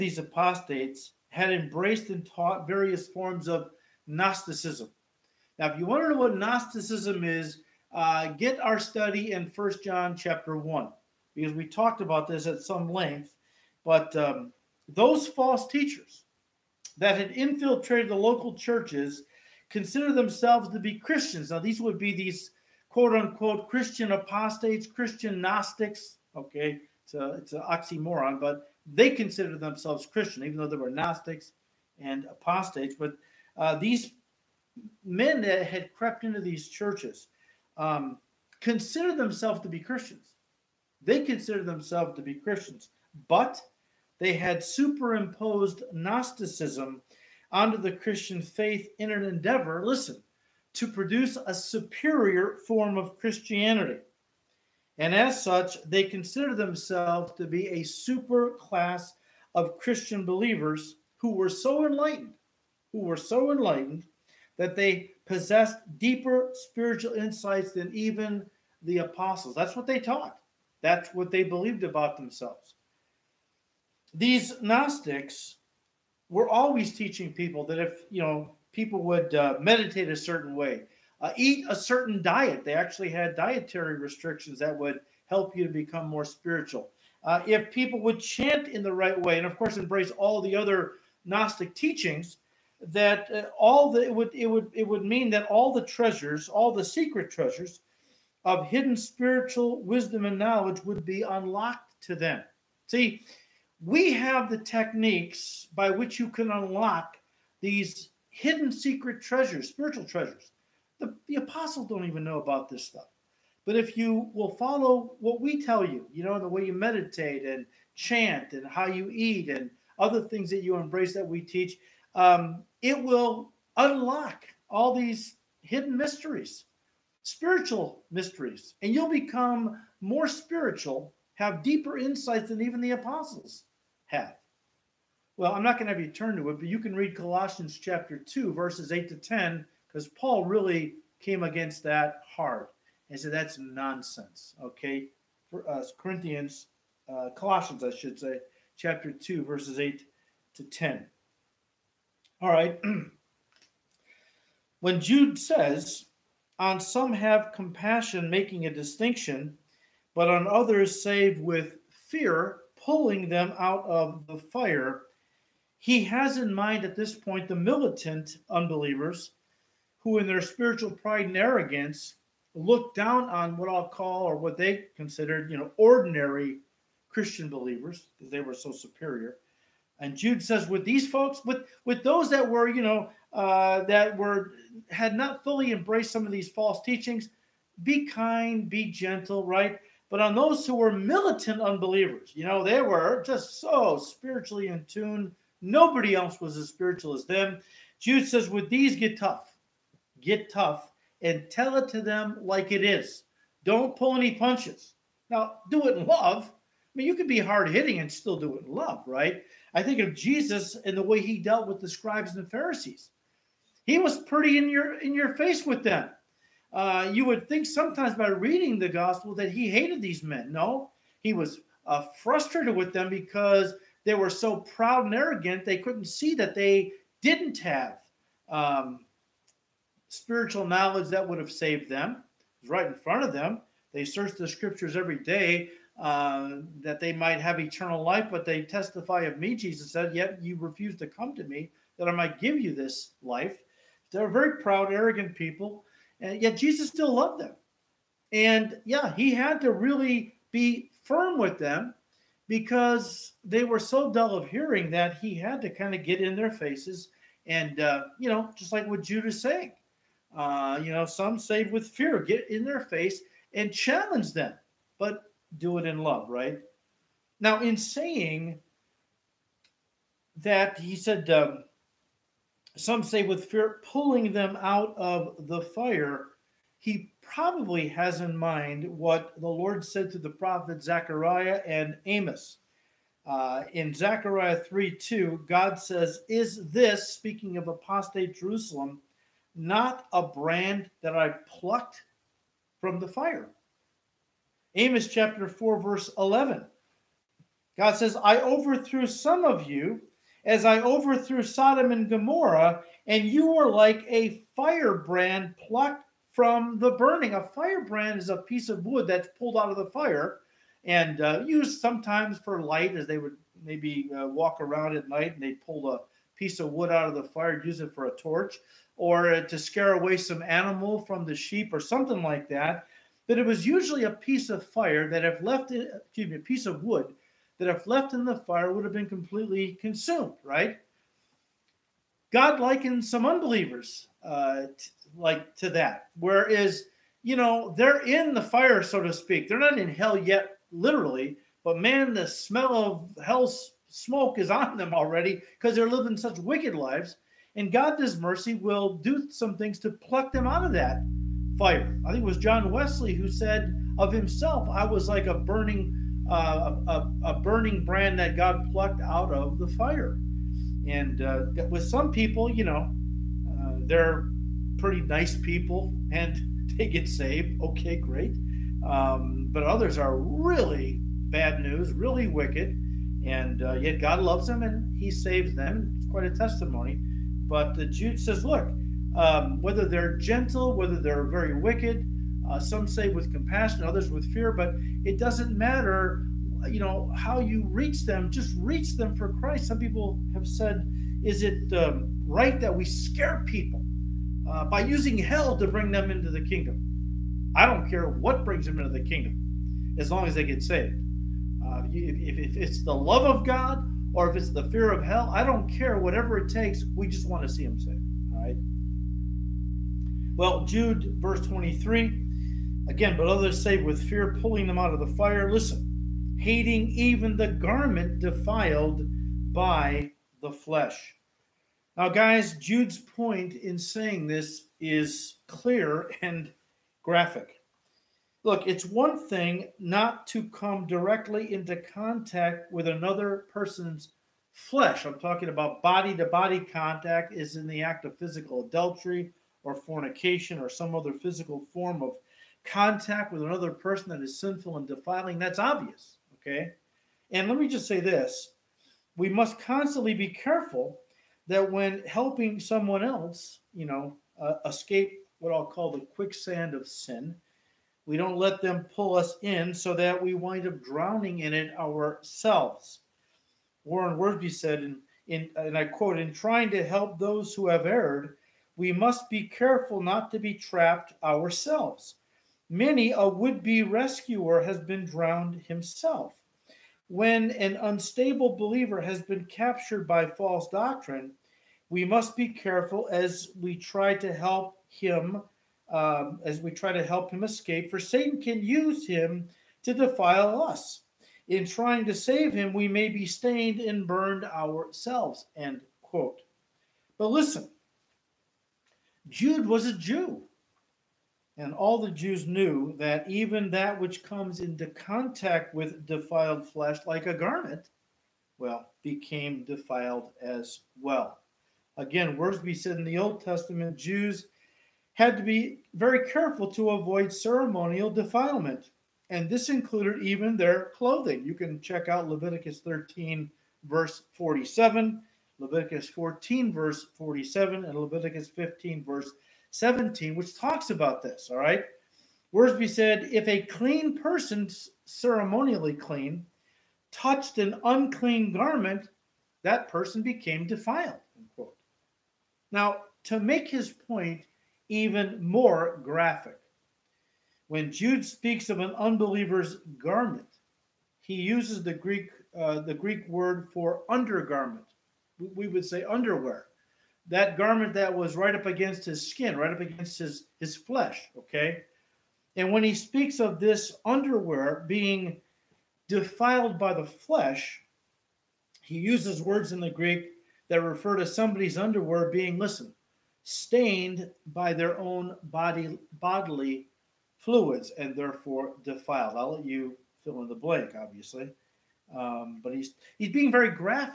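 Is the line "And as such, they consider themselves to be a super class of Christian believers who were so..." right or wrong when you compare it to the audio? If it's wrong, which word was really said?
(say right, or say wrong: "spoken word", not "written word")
right.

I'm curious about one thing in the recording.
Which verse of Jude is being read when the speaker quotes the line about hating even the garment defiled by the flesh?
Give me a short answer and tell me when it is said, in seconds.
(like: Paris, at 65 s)
Verse 23, at 411 s.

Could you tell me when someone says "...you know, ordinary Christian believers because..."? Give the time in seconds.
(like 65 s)
175 s.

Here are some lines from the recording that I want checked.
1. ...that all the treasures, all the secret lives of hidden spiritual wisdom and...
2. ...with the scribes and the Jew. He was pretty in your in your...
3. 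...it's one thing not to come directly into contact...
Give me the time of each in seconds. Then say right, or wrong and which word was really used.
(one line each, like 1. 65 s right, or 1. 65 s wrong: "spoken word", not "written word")
1. 95 s wrong: "treasures", not "lives"
2. 211 s wrong: "Pharisees", not "Jew"
3. 428 s right.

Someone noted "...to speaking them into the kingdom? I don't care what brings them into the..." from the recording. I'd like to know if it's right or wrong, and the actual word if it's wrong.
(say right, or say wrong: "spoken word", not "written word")
wrong: "bring", not "speaking".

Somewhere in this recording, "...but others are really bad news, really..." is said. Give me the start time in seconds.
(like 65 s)
369 s.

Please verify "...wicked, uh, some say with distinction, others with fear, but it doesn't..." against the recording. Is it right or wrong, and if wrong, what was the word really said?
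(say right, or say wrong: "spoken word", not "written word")
wrong: "compassion", not "distinction".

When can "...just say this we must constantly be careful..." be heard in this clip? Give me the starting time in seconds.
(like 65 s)
447 s.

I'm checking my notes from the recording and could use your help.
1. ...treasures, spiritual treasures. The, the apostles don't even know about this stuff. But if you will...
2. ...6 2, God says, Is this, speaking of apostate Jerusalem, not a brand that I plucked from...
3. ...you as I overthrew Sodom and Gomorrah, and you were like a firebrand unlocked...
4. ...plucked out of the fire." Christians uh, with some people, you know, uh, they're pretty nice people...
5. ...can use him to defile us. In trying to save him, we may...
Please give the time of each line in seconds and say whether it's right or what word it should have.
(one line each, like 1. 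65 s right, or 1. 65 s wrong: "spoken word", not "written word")
1. 109 s right
2. 284 s wrong: "3", not "6"
3. 299 s wrong: "plucked", not "unlocked"
4. 358 s wrong: "And", not "Christians"
5. 488 s right.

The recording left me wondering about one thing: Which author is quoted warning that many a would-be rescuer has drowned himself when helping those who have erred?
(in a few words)
Warren Wiersbe.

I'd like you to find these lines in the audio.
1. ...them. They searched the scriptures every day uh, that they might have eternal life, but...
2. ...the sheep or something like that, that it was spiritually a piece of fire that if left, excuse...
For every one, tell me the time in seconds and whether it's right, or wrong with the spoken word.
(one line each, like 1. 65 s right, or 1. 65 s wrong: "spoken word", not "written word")
1. 233 s right
2. 321 s wrong: "usually", not "spiritually".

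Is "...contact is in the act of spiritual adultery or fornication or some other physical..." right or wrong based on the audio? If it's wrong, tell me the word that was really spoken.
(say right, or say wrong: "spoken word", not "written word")
wrong: "physical", not "spiritual".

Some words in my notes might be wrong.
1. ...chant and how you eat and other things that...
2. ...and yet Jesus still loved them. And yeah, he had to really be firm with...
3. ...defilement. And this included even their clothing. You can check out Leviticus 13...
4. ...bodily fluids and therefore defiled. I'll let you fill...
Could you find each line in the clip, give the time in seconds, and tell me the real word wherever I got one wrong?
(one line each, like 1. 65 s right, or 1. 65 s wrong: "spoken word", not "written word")
1. 117 s right
2. 246 s right
3. 518 s right
4. 576 s right.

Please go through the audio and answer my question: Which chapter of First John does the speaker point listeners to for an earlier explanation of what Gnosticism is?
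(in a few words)
Chapter 1.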